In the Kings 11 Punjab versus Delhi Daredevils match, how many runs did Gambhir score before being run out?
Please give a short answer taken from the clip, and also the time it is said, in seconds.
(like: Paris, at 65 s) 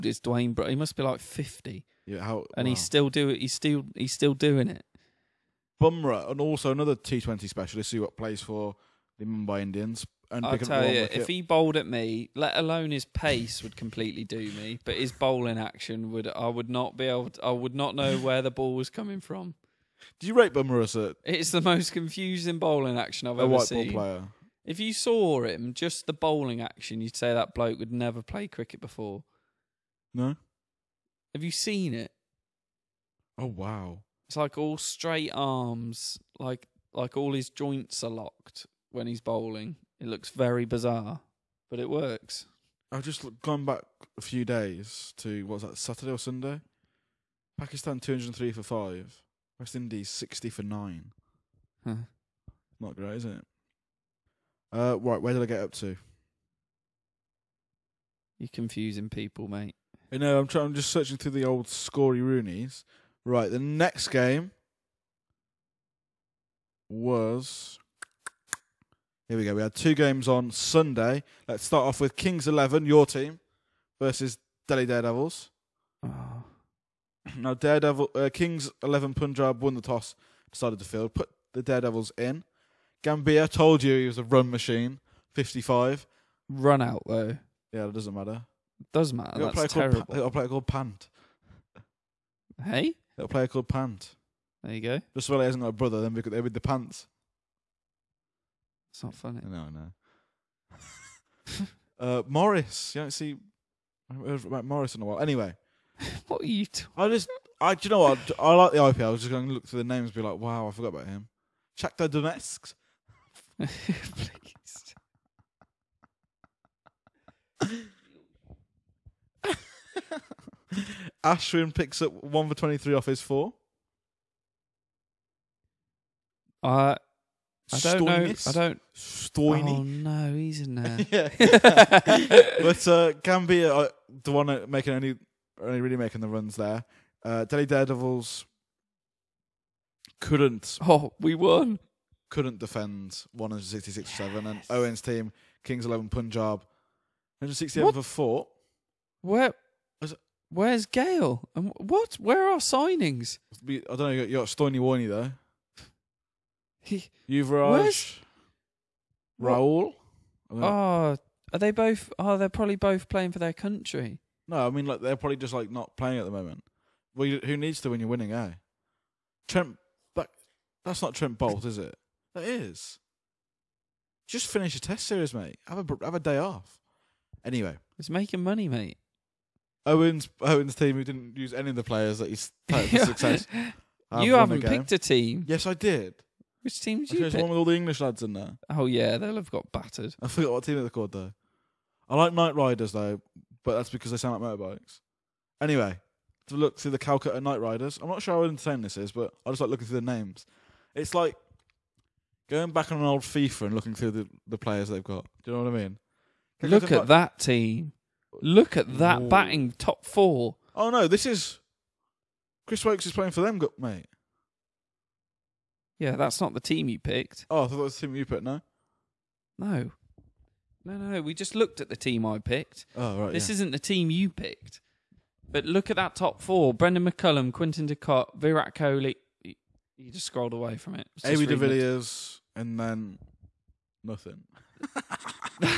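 55, at 85 s.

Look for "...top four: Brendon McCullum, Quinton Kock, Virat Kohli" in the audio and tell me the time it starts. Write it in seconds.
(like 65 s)
226 s.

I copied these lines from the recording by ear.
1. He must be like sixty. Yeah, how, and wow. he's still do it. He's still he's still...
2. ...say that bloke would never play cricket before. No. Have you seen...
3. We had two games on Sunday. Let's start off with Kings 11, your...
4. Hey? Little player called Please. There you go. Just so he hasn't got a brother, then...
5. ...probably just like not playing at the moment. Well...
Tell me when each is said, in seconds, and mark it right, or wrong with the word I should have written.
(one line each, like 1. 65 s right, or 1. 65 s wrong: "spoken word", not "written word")
1. 0 s wrong: "fifty", not "sixty"
2. 27 s right
3. 69 s right
4. 92 s wrong: "Pant", not "Please"
5. 165 s right.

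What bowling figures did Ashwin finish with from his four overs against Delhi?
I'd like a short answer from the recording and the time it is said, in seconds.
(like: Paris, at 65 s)
1 for 23, at 122 s.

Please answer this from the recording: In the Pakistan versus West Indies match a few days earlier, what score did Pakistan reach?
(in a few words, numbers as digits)
203 for 5.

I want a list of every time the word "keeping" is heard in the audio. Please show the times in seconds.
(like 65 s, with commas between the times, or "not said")
not said.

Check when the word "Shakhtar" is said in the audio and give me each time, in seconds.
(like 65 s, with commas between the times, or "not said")
111 s.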